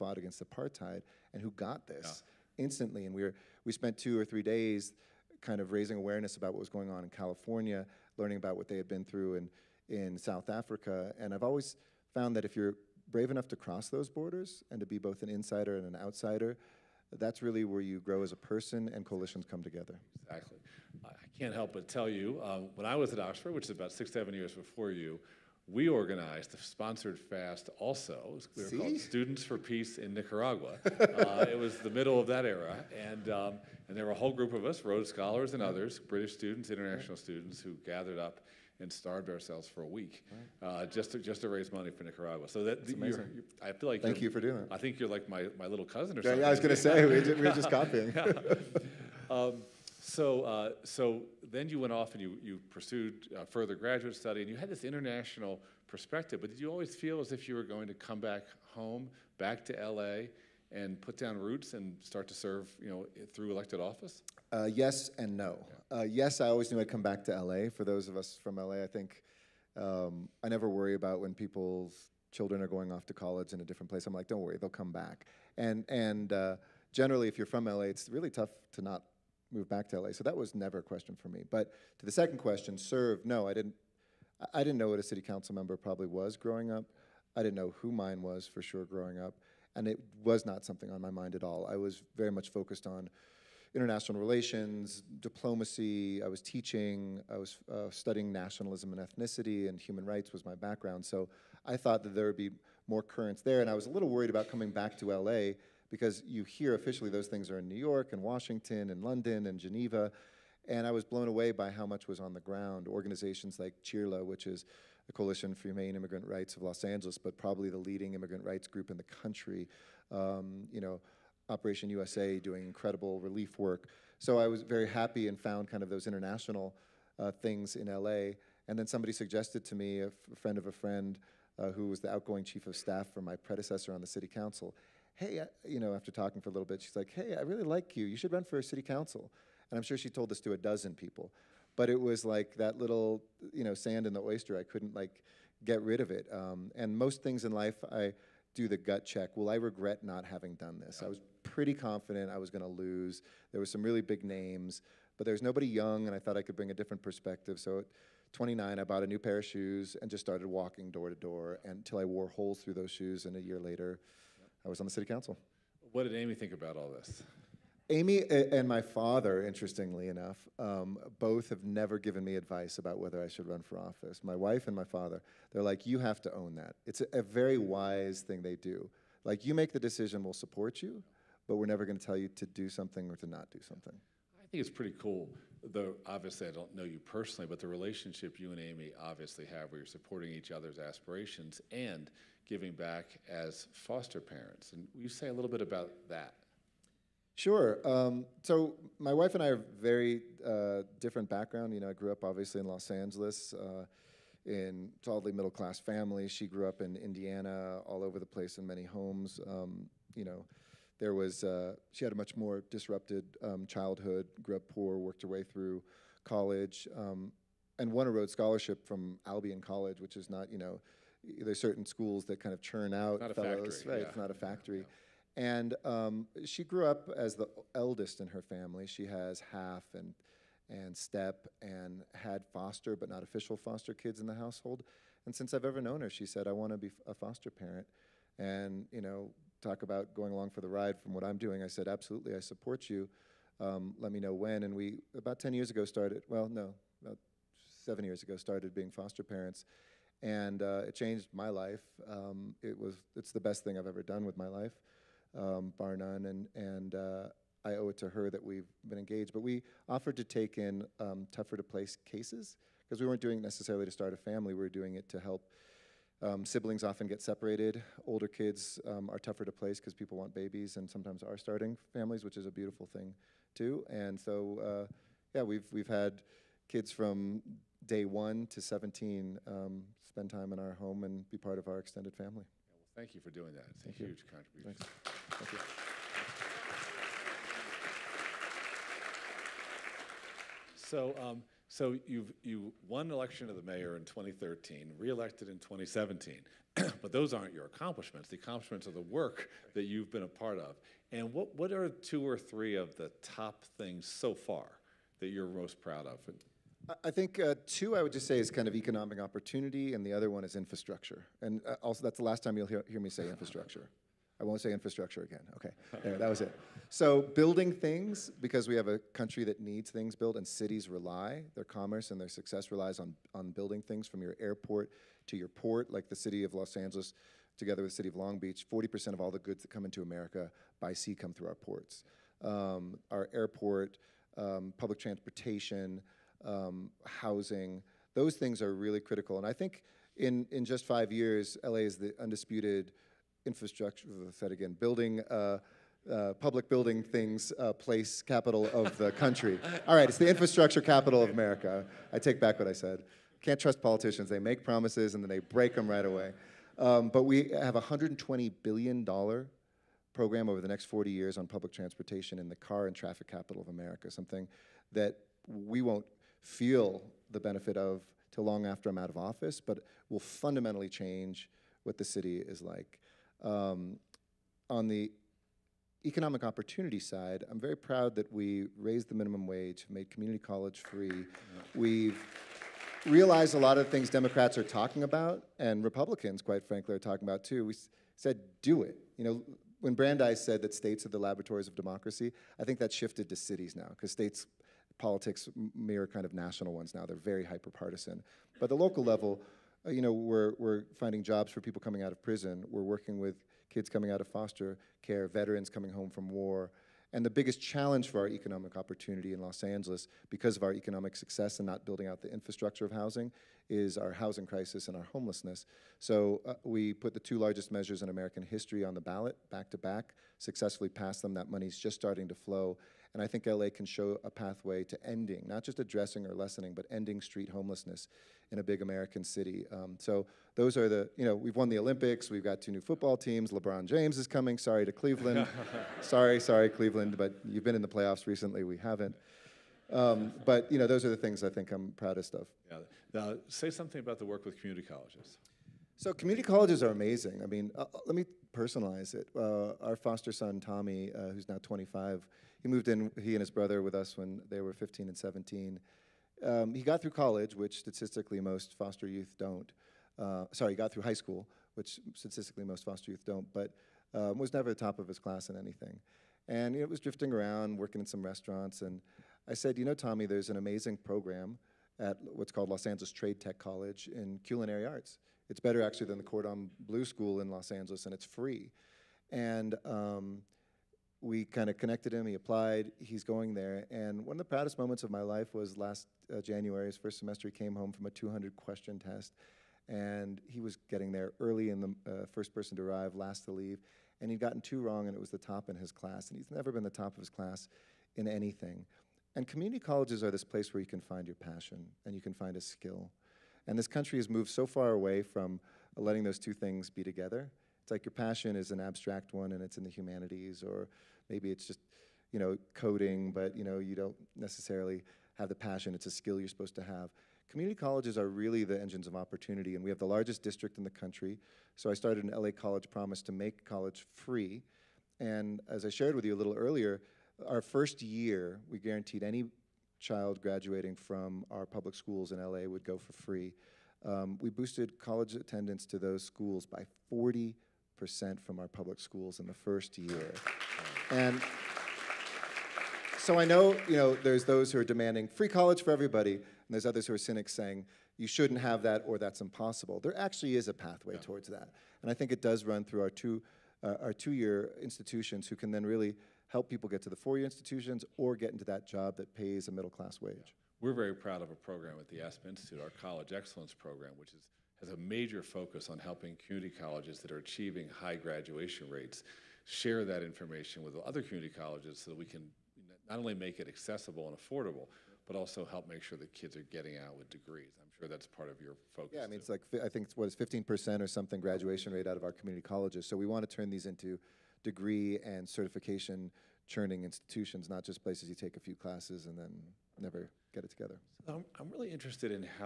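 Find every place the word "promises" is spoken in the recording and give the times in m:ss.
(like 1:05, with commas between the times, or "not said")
5:54, 8:42.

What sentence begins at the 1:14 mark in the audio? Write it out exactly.
I'm like, don't worry, they'll come back.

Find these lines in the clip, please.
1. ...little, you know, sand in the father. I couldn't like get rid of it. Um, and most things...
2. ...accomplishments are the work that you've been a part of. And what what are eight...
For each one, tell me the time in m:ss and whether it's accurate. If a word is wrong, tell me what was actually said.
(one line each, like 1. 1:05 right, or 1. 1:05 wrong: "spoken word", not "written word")
1. 2:22 wrong: "oyster", not "father"
2. 4:58 wrong: "two", not "eight".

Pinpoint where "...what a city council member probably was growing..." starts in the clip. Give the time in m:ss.
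1:24.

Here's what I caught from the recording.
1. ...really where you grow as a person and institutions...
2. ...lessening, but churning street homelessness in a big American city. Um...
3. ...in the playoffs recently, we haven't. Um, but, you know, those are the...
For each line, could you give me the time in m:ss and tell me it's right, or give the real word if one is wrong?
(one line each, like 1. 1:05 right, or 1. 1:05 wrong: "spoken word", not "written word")
1. 0:17 wrong: "coalitions", not "institutions"
2. 7:06 wrong: "ending", not "churning"
3. 7:17 right.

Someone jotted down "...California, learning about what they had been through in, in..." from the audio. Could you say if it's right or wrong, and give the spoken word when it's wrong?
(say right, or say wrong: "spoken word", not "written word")
right.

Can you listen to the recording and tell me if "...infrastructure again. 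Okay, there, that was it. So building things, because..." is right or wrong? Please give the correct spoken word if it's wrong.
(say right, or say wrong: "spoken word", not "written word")
right.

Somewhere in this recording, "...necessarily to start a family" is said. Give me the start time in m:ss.
4:23.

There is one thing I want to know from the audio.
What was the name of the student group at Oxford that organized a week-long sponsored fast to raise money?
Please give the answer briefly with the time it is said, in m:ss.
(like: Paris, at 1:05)
Students for Peace in Nicaragua, at 0:28.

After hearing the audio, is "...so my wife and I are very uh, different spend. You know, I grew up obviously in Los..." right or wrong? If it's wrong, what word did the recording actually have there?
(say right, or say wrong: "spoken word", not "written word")
wrong: "background", not "spend".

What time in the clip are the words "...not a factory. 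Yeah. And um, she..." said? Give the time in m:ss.
3:44.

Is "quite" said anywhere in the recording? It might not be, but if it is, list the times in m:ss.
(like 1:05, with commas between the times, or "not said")
6:26.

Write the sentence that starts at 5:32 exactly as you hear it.
Um, our airport, um, public transportation, um, housing.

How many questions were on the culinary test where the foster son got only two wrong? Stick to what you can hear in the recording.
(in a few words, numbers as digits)
200.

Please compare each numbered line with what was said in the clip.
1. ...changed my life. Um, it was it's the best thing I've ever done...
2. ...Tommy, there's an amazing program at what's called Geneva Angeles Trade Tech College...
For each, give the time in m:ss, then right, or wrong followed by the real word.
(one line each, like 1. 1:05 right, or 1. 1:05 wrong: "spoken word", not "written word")
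1. 4:10 right
2. 7:49 wrong: "Los", not "Geneva".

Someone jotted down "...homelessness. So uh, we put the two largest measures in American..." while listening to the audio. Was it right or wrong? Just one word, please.
right.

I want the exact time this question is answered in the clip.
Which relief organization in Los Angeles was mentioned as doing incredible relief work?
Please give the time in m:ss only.
2:01.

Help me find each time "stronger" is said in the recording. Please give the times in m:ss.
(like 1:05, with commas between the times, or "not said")
not said.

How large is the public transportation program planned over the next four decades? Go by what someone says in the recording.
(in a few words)
$120 billion.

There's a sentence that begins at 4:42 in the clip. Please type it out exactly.
Yeah, well, thank you for doing that.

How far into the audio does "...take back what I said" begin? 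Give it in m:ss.
5:52.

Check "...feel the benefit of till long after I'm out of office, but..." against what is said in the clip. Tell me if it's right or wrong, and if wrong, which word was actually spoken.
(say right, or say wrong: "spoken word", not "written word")
right.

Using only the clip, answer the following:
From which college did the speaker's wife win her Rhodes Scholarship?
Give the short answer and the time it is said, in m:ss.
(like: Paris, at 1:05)
Albion College, at 3:39.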